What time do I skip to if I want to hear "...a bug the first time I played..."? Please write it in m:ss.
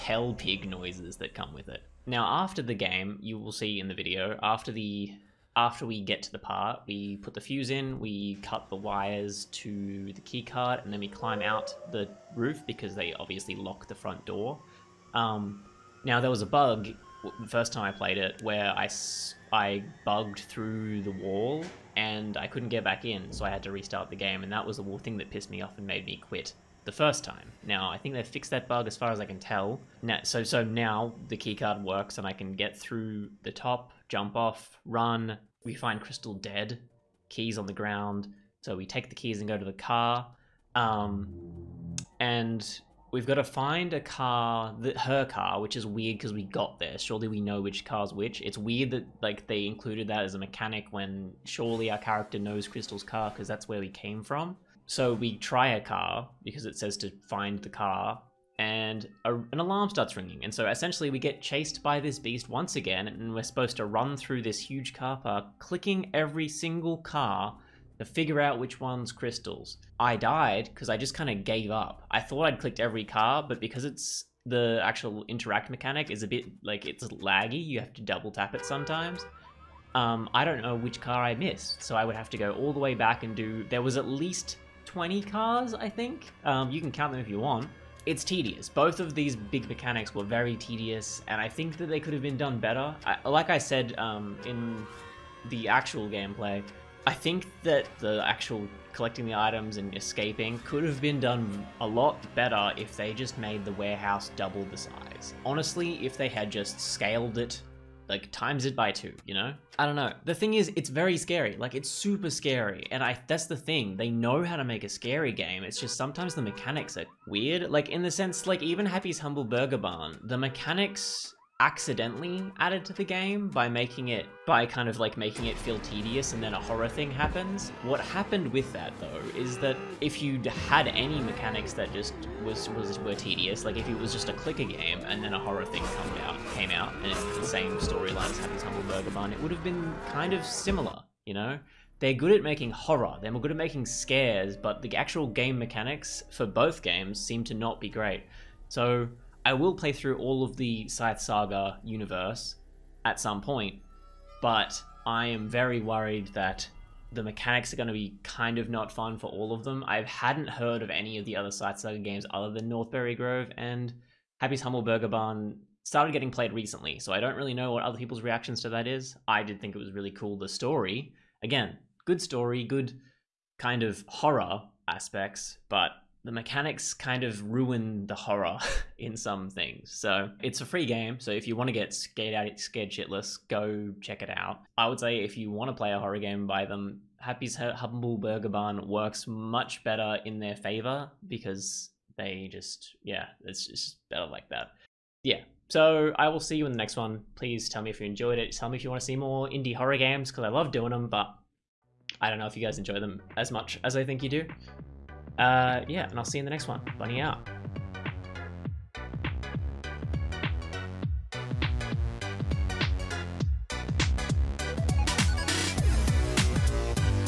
0:16.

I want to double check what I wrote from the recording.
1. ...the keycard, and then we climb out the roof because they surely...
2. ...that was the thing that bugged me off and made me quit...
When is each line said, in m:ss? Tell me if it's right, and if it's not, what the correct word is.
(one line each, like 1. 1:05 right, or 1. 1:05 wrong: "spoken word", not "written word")
1. 0:10 wrong: "obviously", not "surely"
2. 0:24 wrong: "pissed", not "bugged".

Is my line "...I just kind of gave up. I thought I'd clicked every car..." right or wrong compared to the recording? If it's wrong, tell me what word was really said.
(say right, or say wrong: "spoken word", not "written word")
right.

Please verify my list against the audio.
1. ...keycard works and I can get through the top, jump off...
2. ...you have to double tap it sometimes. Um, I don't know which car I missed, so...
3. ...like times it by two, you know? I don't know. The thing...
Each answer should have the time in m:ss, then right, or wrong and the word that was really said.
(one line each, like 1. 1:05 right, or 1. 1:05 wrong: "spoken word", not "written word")
1. 0:31 right
2. 1:17 right
3. 1:48 right.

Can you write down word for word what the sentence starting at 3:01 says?
So if you want to get scared out, scared shitless, go check it out.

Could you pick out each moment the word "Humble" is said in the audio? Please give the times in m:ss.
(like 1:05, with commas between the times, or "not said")
1:59, 2:18, 2:44, 3:07.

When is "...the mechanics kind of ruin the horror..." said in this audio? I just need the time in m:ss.
2:56.